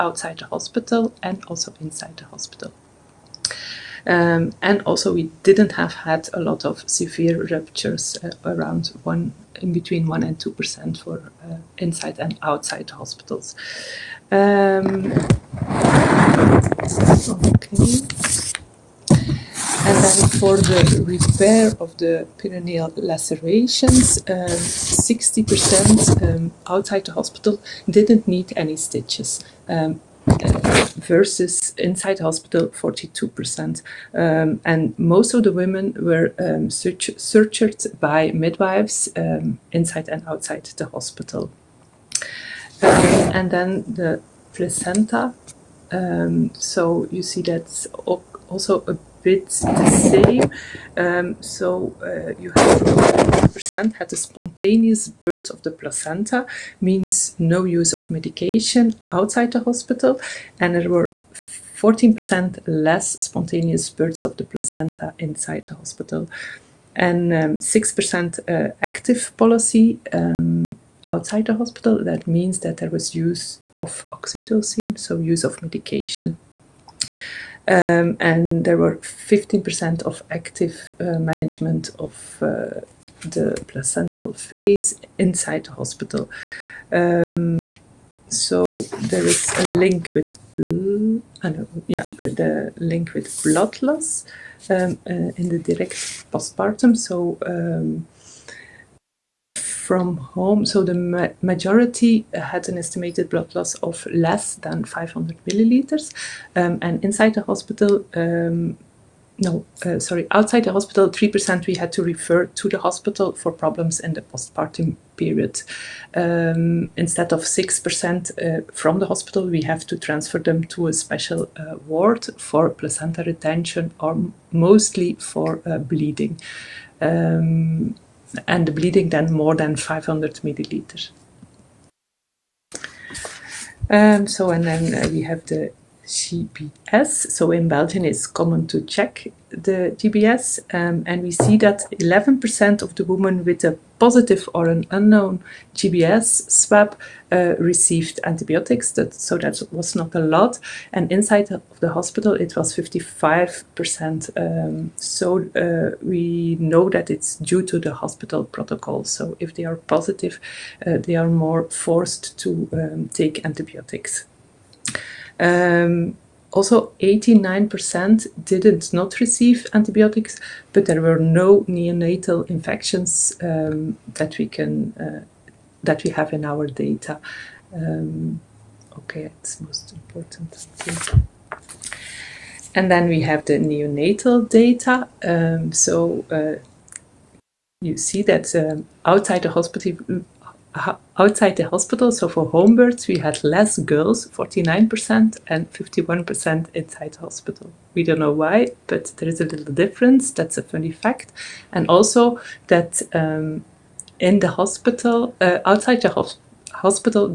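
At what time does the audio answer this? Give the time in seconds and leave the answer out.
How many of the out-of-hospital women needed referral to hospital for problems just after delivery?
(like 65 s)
111 s.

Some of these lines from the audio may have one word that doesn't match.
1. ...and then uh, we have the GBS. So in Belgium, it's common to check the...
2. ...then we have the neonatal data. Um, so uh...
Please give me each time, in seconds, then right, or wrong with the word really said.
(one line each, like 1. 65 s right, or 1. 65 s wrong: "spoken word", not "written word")
1. 134 s right
2. 182 s right.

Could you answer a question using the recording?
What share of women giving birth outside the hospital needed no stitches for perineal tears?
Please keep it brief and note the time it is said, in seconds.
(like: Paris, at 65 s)
60%, at 24 s.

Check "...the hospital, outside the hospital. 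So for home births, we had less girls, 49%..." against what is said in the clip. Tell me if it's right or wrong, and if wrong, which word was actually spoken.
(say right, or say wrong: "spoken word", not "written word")
right.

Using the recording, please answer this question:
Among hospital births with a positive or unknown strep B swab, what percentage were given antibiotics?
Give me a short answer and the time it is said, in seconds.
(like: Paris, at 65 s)
55%, at 152 s.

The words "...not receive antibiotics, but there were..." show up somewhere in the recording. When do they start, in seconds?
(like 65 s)
168 s.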